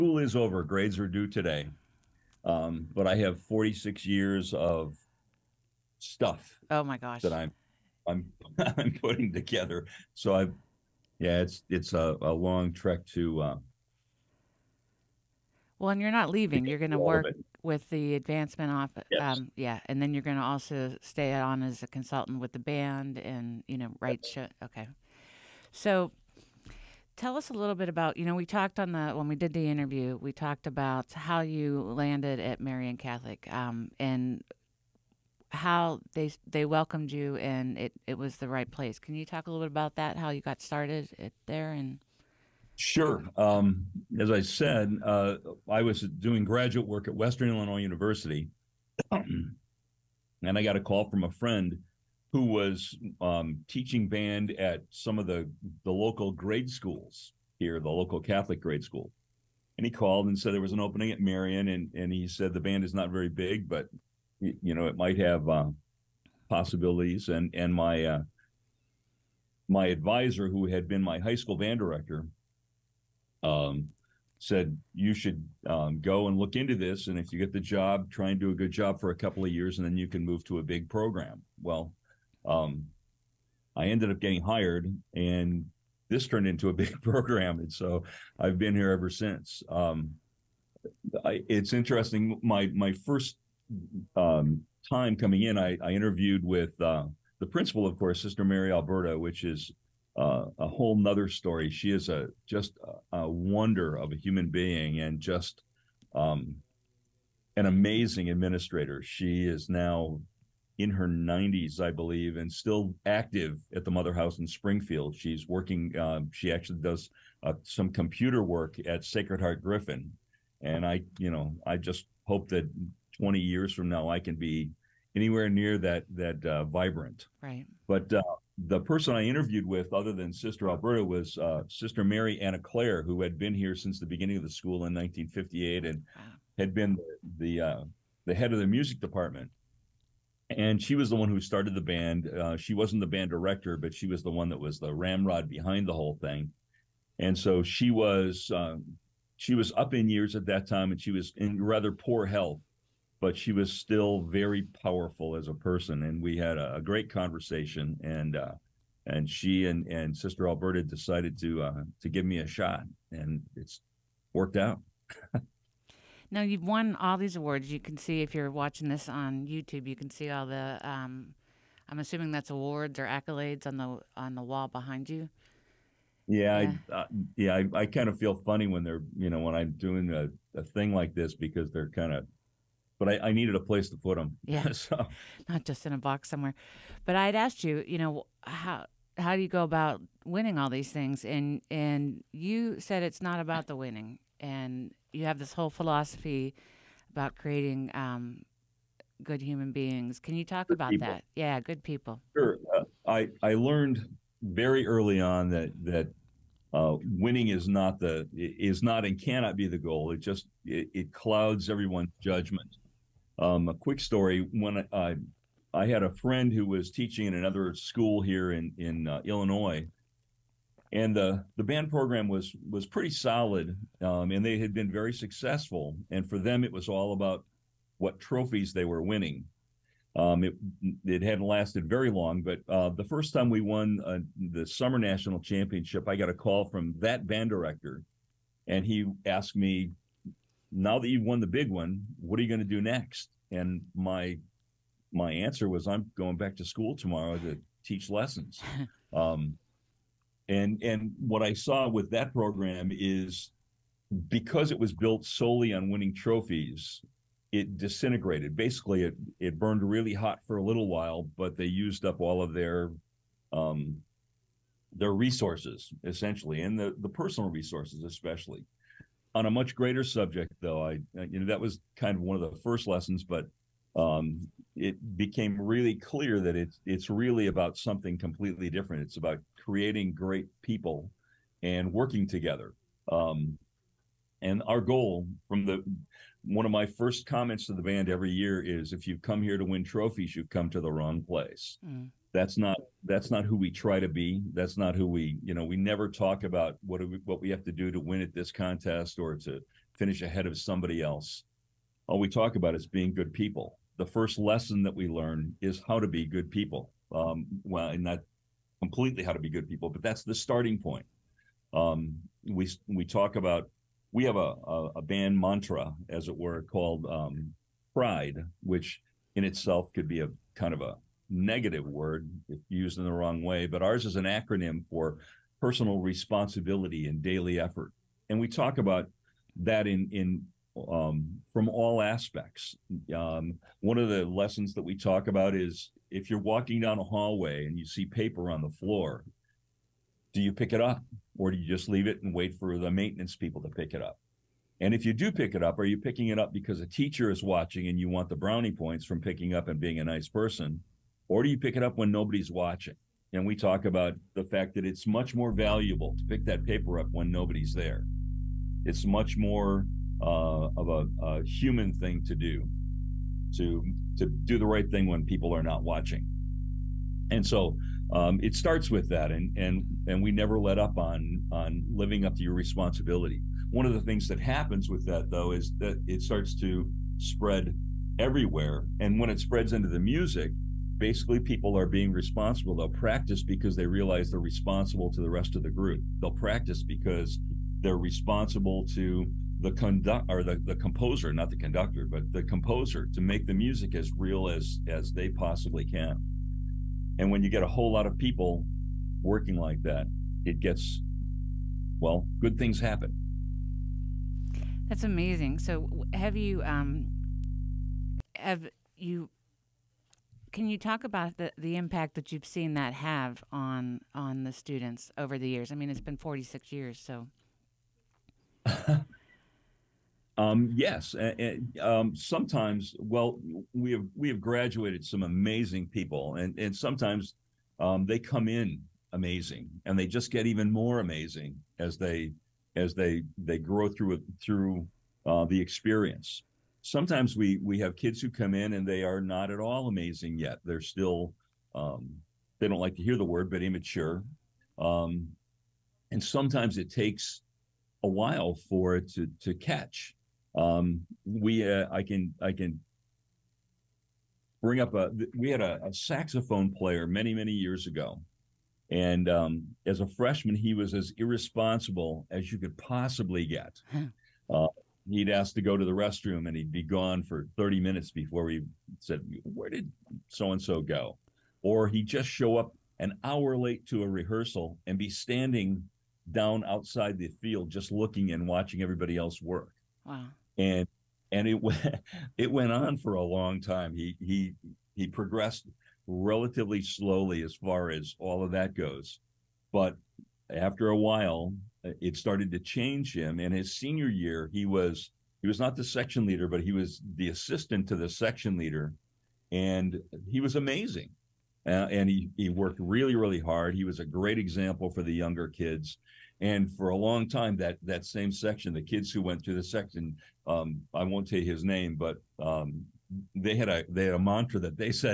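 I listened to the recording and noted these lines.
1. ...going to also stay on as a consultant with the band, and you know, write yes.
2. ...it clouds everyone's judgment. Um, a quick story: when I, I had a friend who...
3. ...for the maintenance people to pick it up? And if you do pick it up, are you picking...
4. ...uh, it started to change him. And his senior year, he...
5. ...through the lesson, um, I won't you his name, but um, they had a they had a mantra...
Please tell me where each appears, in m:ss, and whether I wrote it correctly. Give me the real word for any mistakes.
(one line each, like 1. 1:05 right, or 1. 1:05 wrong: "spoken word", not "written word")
1. 0:20 right
2. 3:30 right
3. 5:42 right
4. 8:11 right
5. 8:29 wrong: "section", not "lesson".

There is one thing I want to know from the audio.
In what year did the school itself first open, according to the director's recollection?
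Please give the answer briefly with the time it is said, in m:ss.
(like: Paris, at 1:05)
1958, at 2:14.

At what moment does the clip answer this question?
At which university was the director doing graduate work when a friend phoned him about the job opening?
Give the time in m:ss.
0:47.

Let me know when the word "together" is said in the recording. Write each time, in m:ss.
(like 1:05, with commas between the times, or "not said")
0:09, 4:42.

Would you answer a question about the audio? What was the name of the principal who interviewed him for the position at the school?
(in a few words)
Sister Mary Alberta.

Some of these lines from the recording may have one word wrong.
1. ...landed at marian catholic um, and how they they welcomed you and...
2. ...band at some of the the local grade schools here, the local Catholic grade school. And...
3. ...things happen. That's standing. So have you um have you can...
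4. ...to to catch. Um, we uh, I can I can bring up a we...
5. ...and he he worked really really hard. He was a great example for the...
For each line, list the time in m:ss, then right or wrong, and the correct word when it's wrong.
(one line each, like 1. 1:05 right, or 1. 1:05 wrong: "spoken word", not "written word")
1. 0:31 right
2. 0:54 right
3. 6:42 wrong: "amazing", not "standing"
4. 7:29 right
5. 8:21 right.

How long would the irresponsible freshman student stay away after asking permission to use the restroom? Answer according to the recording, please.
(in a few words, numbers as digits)
30 minutes.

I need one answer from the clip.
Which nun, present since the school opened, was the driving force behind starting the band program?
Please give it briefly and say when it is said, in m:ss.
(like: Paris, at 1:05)
Sister Mary Anna Claire, at 2:11.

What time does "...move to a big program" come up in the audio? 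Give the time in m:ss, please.
1:20.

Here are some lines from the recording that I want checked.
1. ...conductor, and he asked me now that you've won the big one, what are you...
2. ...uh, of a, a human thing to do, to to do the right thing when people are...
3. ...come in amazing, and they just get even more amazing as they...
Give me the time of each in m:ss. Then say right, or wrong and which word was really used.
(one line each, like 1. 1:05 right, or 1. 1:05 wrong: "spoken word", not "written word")
1. 3:57 wrong: "director", not "conductor"
2. 6:00 right
3. 7:08 right.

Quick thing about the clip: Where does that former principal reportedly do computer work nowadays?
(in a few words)
Sacred Heart Griffin.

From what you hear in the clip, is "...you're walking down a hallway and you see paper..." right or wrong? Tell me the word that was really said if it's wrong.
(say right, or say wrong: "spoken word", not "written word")
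right.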